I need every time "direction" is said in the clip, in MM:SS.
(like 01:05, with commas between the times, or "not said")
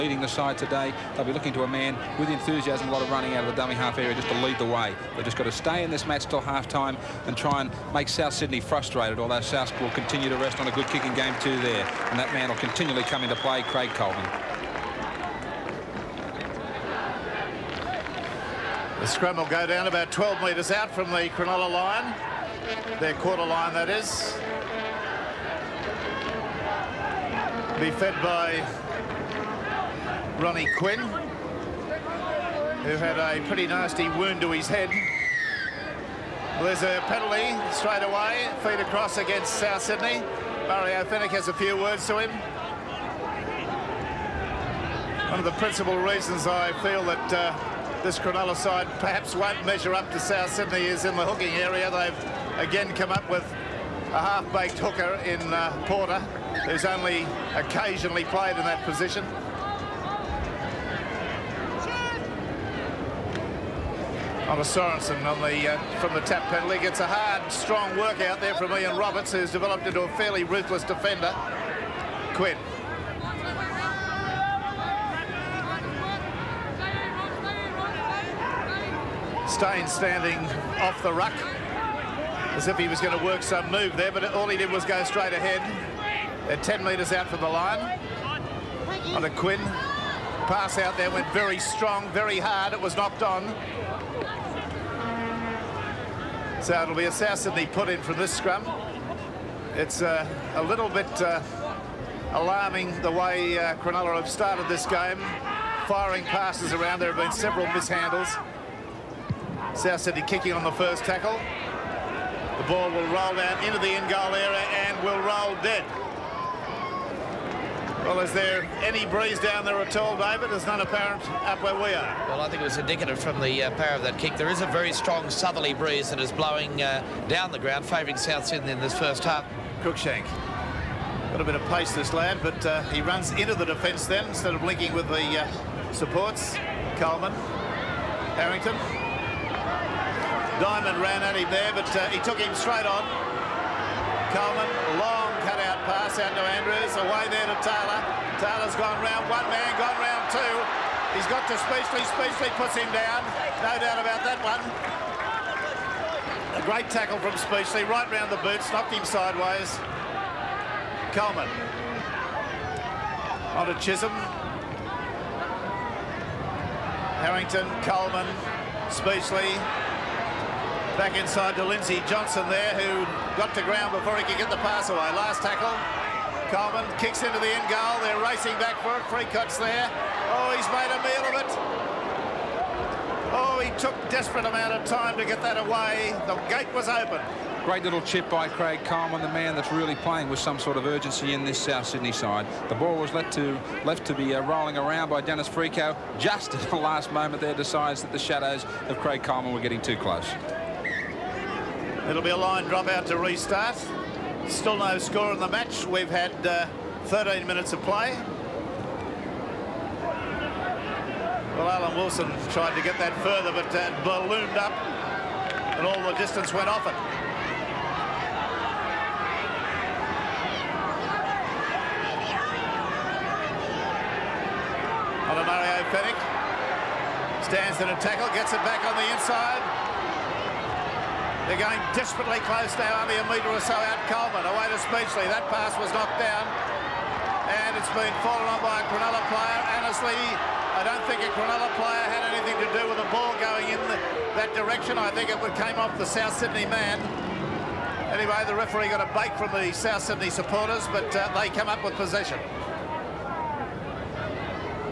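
04:04.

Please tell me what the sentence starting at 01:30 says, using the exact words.
Pass out there went very strong, very hard.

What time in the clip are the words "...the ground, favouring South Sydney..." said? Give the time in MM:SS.
02:07.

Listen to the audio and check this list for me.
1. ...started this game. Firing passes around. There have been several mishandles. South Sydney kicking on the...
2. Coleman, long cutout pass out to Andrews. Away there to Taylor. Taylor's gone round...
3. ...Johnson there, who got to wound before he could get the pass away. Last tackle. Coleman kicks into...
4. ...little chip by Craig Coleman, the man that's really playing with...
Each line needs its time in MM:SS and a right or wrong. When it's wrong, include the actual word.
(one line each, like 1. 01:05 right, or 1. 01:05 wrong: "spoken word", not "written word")
1. 01:44 right
2. 02:24 right
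3. 02:52 wrong: "ground", not "wound"
4. 03:07 right.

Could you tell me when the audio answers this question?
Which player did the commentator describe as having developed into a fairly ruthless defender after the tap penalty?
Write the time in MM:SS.
01:08.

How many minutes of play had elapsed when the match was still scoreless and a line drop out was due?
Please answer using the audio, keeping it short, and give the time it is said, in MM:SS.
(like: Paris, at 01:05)
13, at 03:27.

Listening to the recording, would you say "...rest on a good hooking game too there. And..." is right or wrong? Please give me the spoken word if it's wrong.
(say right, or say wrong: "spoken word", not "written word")
wrong: "kicking", not "hooking".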